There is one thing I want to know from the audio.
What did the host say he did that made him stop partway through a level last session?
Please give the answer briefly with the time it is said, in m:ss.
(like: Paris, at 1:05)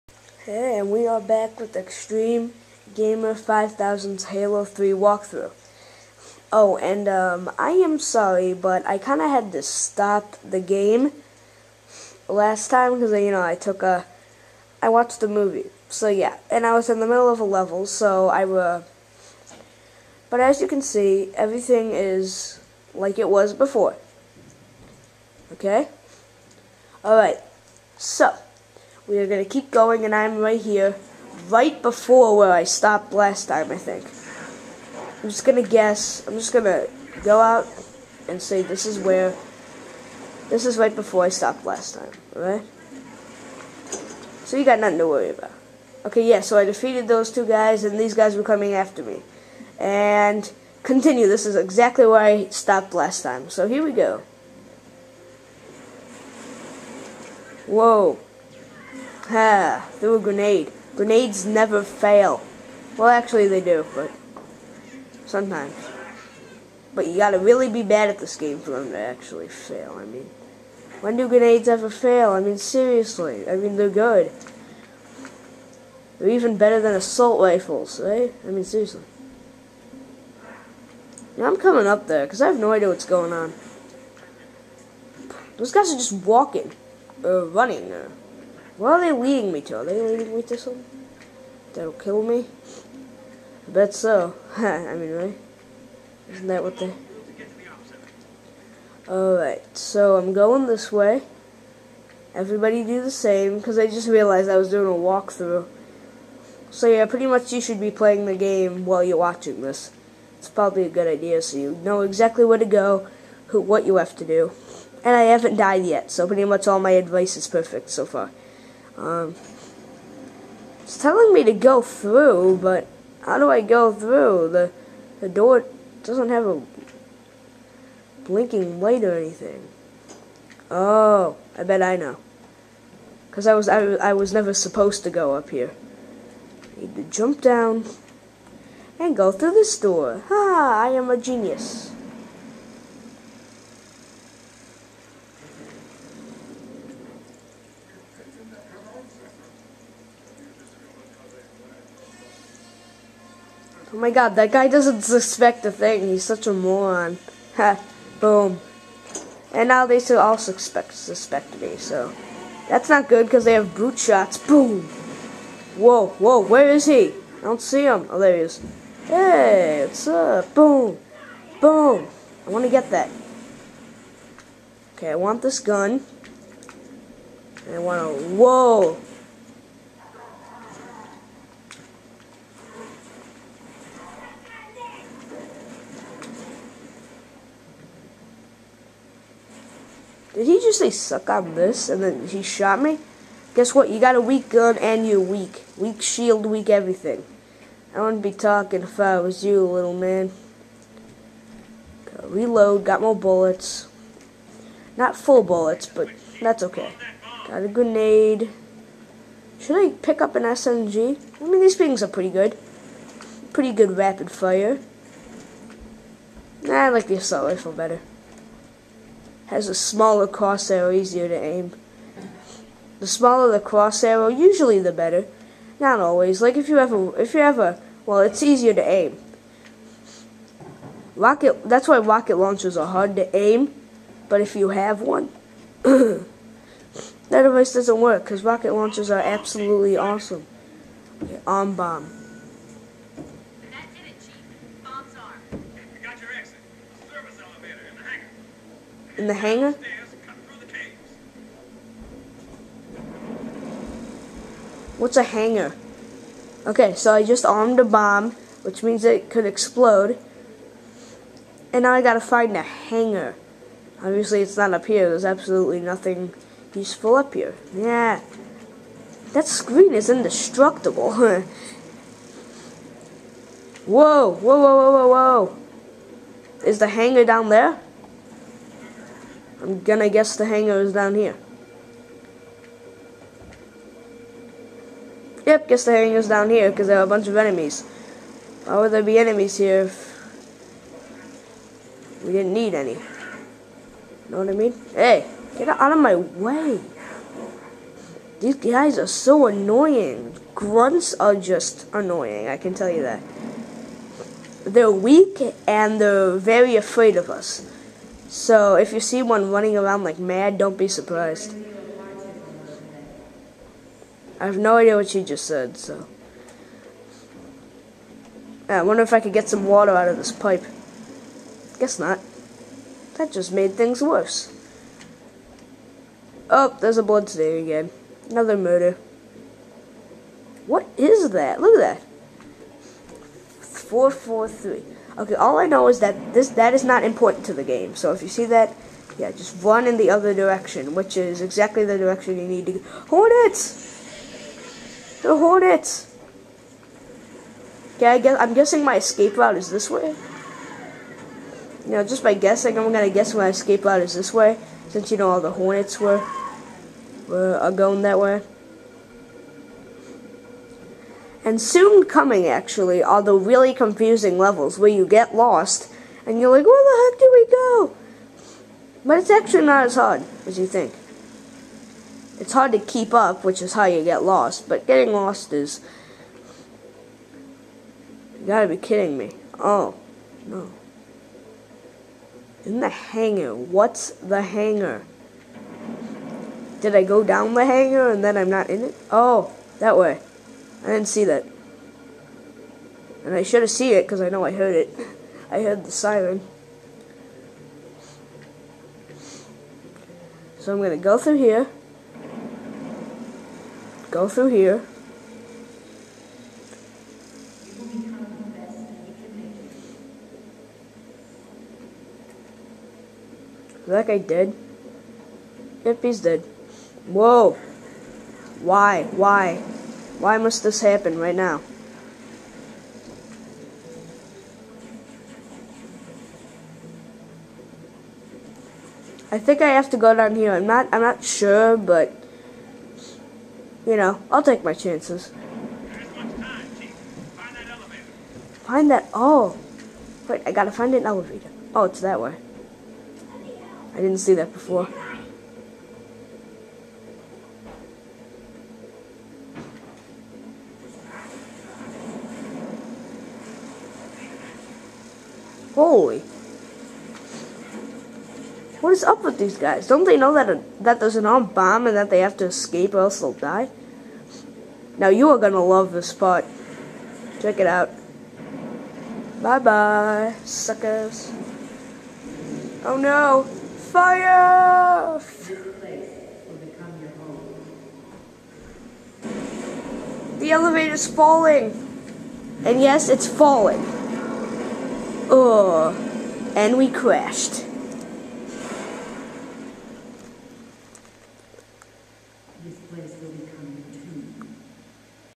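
watched a movie, at 0:14.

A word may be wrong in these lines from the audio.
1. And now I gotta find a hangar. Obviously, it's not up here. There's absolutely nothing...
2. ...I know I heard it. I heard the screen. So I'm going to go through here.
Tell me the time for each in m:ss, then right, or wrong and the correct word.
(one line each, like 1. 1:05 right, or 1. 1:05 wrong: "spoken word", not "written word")
1. 4:21 right
2. 6:34 wrong: "siren", not "screen".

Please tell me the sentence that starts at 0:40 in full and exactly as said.
This is right before I stopped last time, alright?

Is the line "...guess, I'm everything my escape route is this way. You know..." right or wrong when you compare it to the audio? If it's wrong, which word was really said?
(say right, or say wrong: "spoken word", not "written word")
wrong: "guessing", not "everything".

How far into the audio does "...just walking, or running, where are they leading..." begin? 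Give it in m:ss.
1:25.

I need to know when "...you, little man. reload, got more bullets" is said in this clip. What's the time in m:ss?
3:19.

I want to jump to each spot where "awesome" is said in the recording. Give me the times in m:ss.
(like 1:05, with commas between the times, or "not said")
3:59.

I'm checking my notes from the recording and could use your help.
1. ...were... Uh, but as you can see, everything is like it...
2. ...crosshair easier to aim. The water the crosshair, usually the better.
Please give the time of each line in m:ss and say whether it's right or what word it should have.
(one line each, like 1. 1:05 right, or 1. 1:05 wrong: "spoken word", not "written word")
1. 0:18 right
2. 3:40 wrong: "smaller", not "water".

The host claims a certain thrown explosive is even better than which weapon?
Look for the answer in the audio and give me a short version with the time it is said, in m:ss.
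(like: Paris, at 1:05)
assault rifles, at 1:16.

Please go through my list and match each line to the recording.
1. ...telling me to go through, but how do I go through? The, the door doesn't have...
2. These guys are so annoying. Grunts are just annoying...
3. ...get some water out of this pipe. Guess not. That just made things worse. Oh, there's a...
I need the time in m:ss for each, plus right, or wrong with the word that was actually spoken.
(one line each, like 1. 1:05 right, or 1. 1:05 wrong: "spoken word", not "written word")
1. 2:00 right
2. 4:58 right
3. 5:19 right.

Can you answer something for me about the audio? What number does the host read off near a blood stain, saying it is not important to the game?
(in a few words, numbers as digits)
443.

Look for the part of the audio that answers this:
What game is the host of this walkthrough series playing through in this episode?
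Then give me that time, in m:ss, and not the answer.
0:04.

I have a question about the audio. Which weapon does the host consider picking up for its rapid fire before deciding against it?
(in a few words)
SMG.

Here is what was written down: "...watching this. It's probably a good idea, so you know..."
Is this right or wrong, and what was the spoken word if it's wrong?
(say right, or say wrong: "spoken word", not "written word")
right.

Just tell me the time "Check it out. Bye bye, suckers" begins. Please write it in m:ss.
7:47.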